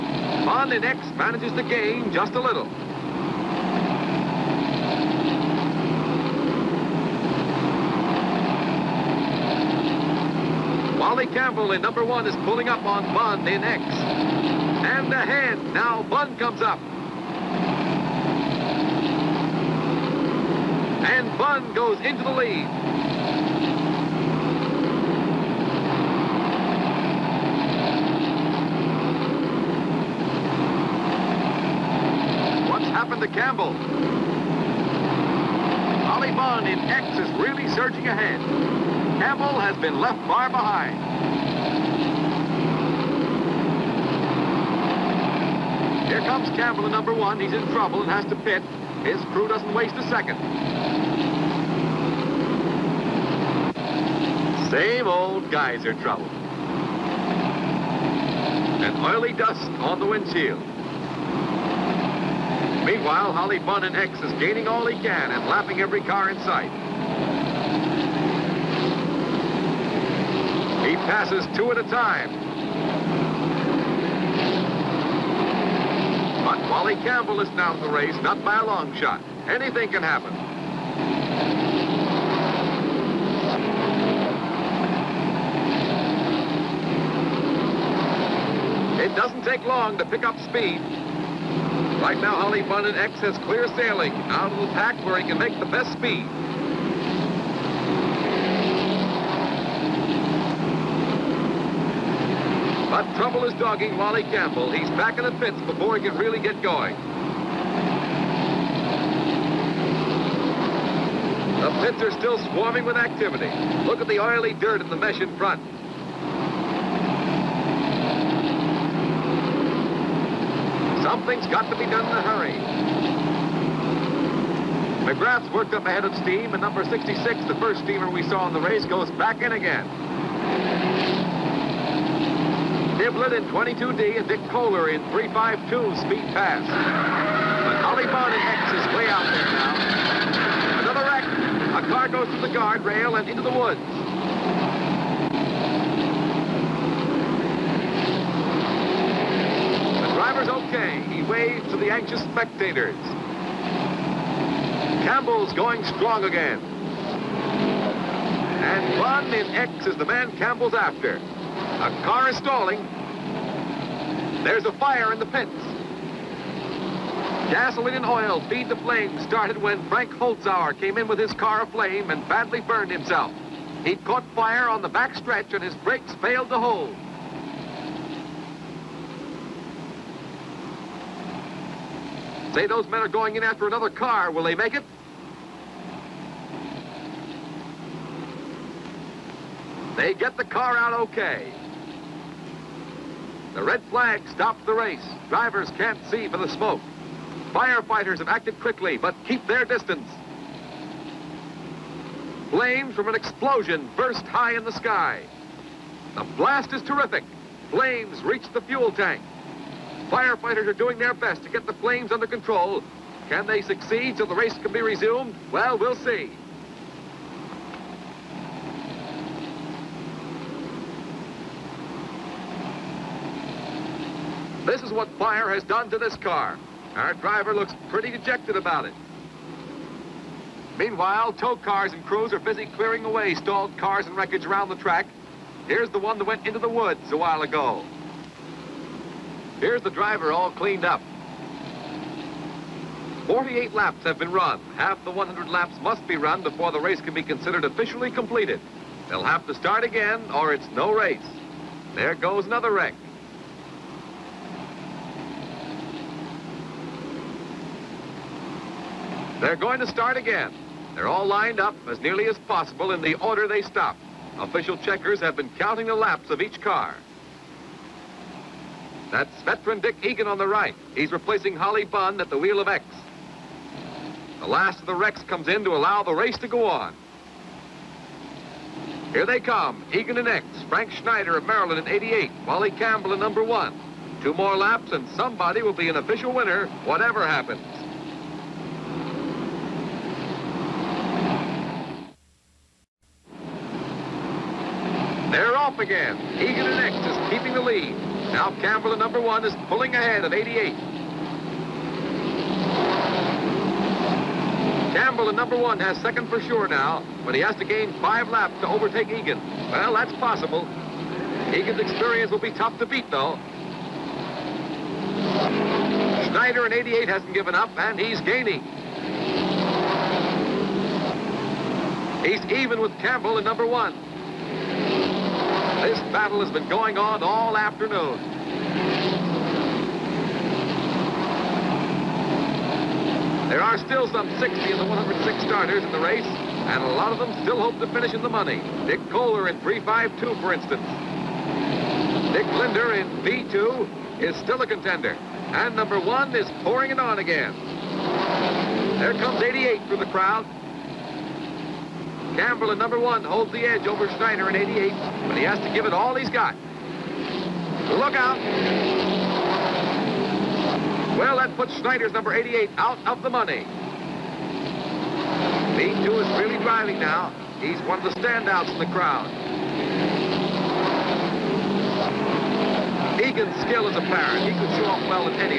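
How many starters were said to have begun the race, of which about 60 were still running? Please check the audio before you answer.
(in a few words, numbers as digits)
106.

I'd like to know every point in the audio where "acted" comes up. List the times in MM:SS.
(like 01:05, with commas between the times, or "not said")
03:18.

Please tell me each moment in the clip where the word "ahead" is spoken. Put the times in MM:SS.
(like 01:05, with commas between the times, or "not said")
00:15, 00:38, 02:05, 04:59.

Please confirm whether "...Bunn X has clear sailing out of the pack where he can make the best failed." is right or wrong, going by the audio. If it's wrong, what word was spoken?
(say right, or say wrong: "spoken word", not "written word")
wrong: "speed", not "failed".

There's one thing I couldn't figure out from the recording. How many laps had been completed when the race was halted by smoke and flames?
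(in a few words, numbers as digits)
48.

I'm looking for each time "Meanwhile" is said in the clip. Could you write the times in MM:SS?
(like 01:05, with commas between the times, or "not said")
01:03, 03:50.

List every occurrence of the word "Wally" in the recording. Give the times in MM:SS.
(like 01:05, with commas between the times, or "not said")
00:10, 01:16, 01:43, 04:42.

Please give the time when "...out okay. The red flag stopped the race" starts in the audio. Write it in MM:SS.
03:10.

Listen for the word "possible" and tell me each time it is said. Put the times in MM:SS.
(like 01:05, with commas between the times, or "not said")
04:22, 05:10.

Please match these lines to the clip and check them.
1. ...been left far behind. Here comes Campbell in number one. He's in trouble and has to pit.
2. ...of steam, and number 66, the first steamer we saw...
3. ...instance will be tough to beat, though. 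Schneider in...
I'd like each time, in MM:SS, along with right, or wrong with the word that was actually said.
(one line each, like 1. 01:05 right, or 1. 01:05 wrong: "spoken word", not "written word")
1. 00:39 right
2. 02:06 right
3. 05:11 wrong: "experience", not "instance".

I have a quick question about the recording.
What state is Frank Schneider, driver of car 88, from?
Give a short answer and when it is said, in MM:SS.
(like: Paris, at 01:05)
Maryland, at 04:41.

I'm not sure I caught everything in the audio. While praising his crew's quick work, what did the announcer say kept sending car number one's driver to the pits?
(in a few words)
Geyser trouble.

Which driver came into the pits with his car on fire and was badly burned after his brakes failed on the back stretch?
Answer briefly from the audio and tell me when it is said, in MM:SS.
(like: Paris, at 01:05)
Frank Holzhauer, at 02:49.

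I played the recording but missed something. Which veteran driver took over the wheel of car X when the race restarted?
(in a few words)
Dick Egan.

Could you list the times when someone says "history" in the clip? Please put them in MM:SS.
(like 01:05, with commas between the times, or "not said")
not said.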